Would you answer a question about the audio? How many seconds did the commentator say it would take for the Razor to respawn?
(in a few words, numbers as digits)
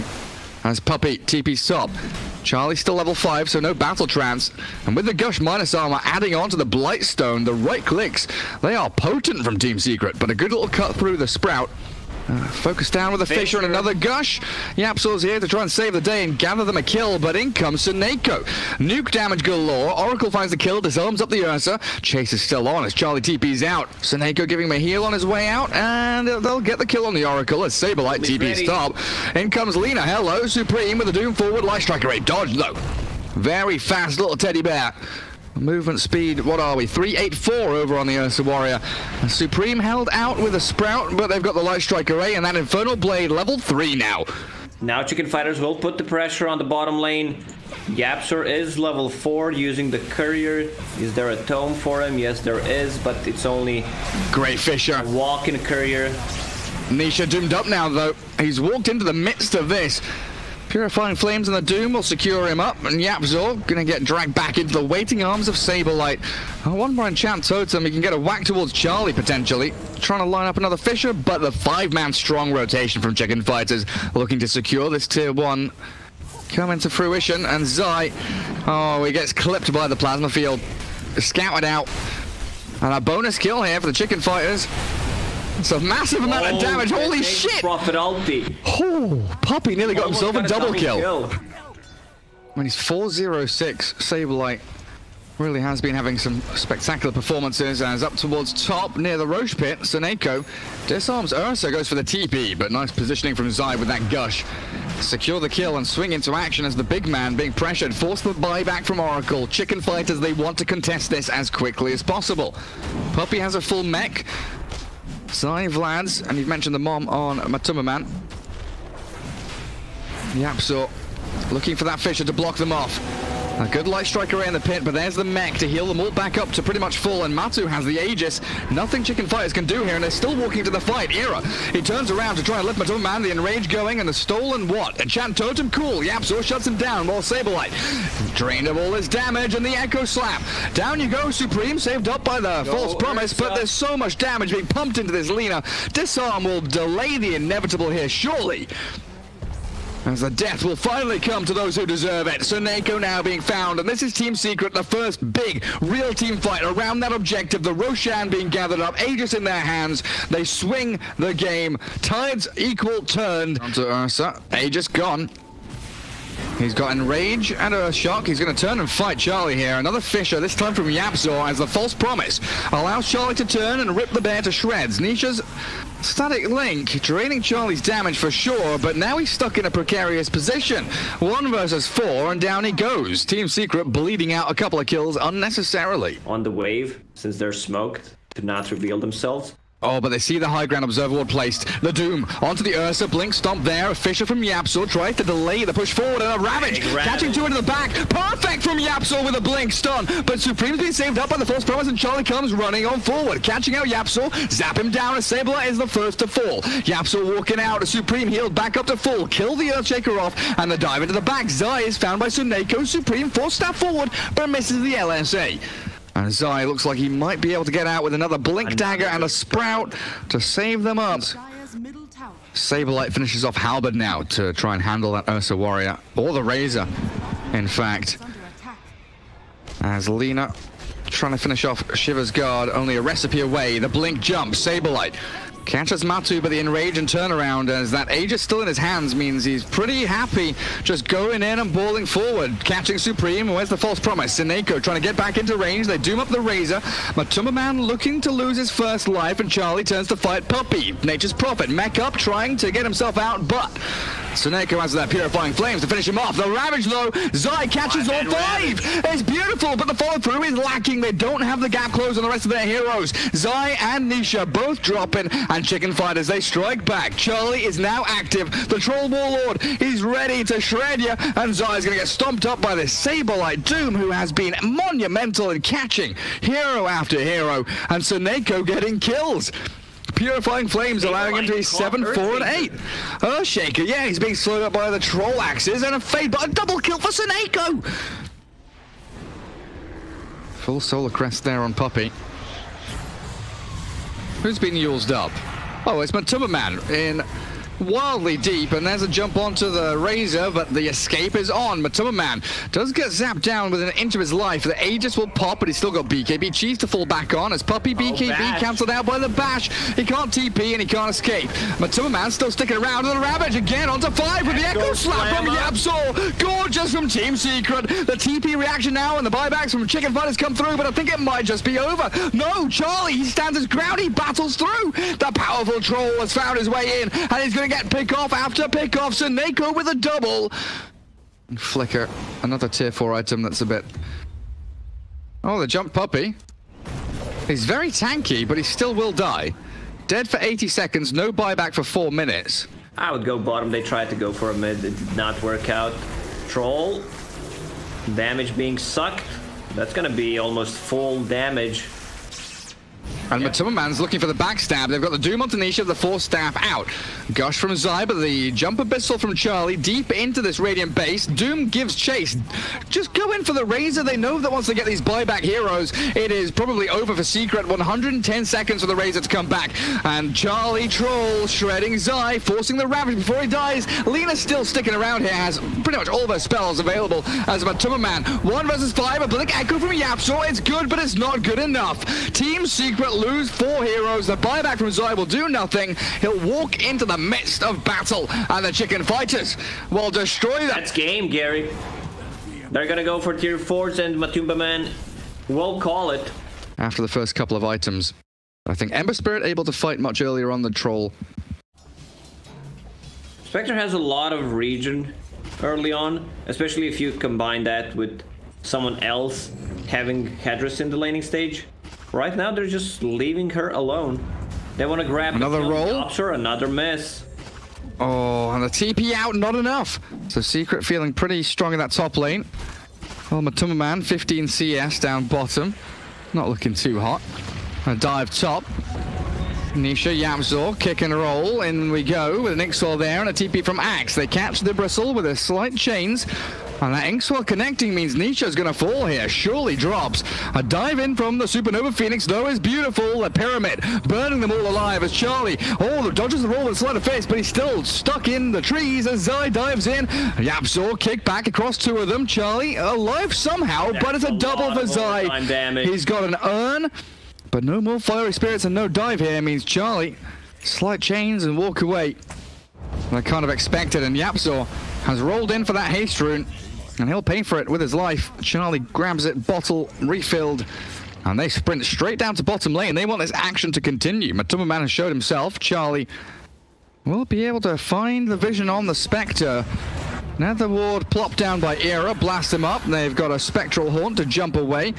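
110.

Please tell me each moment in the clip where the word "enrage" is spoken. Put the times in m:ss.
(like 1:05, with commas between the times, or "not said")
2:13, 2:46, 3:56.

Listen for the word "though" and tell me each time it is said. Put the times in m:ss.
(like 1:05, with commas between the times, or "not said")
0:32, 0:57, 4:16, 7:22.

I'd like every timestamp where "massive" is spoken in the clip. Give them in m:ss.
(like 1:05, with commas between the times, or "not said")
1:25.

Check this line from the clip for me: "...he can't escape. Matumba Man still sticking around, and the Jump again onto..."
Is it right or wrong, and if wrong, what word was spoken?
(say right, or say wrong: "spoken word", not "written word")
wrong: "Ravage", not "Jump".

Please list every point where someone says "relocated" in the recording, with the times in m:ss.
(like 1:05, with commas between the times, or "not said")
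not said.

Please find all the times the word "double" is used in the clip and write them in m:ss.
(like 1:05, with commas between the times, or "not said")
1:30, 4:46, 5:29, 7:34.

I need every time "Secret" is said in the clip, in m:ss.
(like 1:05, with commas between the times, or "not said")
0:09, 2:34, 3:03, 5:17, 6:07, 6:22, 7:00.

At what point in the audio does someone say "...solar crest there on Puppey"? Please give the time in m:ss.
4:50.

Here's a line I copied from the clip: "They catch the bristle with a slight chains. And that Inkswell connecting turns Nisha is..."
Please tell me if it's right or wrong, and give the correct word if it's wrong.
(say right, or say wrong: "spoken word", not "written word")
wrong: "means", not "turns".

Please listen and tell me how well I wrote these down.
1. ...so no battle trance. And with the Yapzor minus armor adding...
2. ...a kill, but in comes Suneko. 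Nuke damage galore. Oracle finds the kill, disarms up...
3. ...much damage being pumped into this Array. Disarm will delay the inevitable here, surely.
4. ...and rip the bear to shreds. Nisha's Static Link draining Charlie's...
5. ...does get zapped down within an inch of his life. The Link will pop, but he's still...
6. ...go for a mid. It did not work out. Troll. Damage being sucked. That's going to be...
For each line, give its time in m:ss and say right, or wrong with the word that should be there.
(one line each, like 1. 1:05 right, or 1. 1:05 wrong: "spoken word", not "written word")
1. 0:03 wrong: "Gush", not "Yapzor"
2. 0:16 right
3. 2:23 wrong: "Lina", not "Array"
4. 2:53 right
5. 5:02 wrong: "Aegis", not "Link"
6. 5:44 right.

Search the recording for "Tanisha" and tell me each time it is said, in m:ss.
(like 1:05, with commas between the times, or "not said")
5:55.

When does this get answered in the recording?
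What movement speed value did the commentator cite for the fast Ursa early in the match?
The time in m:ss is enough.
0:36.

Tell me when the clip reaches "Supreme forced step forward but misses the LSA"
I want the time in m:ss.
3:32.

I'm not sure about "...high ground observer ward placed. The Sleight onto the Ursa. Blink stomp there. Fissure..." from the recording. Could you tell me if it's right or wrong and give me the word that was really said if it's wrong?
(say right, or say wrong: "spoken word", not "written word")
wrong: "Doom", not "Sleight".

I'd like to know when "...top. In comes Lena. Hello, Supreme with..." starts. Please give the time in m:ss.
0:28.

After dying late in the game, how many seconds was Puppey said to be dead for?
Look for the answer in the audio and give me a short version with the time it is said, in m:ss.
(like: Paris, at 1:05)
80, at 5:40.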